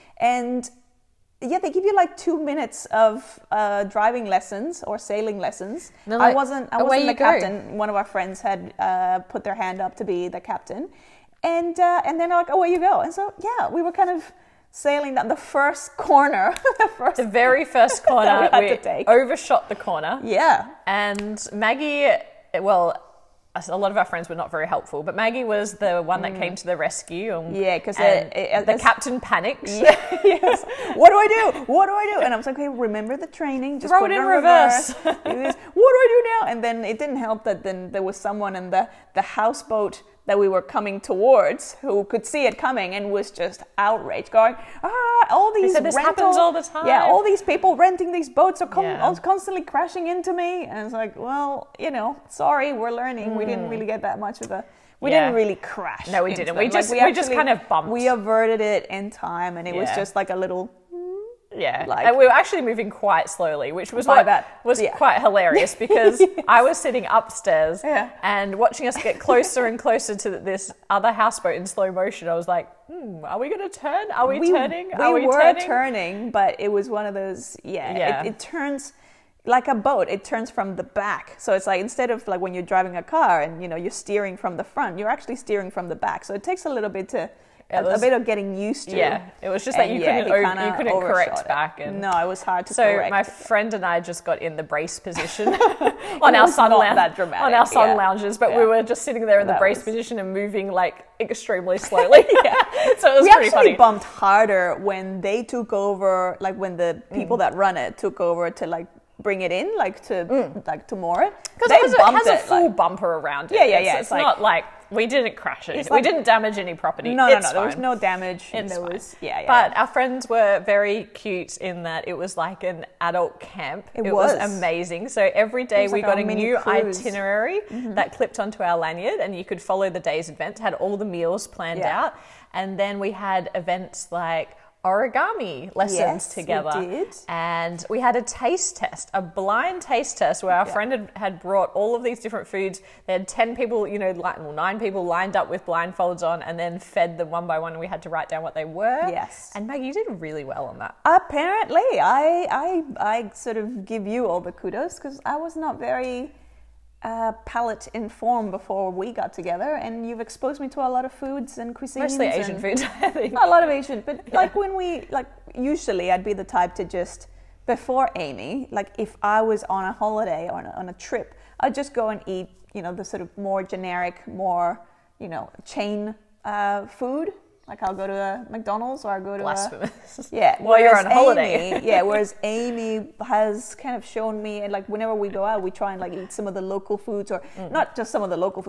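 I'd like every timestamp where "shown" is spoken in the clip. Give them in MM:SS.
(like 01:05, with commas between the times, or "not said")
03:04.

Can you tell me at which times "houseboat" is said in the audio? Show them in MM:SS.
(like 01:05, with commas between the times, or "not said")
00:39, 01:11.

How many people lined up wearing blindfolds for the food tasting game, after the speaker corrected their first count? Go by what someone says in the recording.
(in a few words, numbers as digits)
9.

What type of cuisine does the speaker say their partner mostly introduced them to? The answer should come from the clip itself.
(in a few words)
Asian food.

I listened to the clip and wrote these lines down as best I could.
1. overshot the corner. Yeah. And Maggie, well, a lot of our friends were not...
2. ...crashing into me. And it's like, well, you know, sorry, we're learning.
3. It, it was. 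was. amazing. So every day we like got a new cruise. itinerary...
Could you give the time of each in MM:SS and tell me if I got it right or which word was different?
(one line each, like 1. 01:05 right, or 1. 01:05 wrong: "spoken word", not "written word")
1. 00:19 right
2. 00:49 right
3. 02:03 right.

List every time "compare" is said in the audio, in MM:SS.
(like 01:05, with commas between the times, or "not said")
not said.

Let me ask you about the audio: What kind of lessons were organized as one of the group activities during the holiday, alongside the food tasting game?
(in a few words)
Origami.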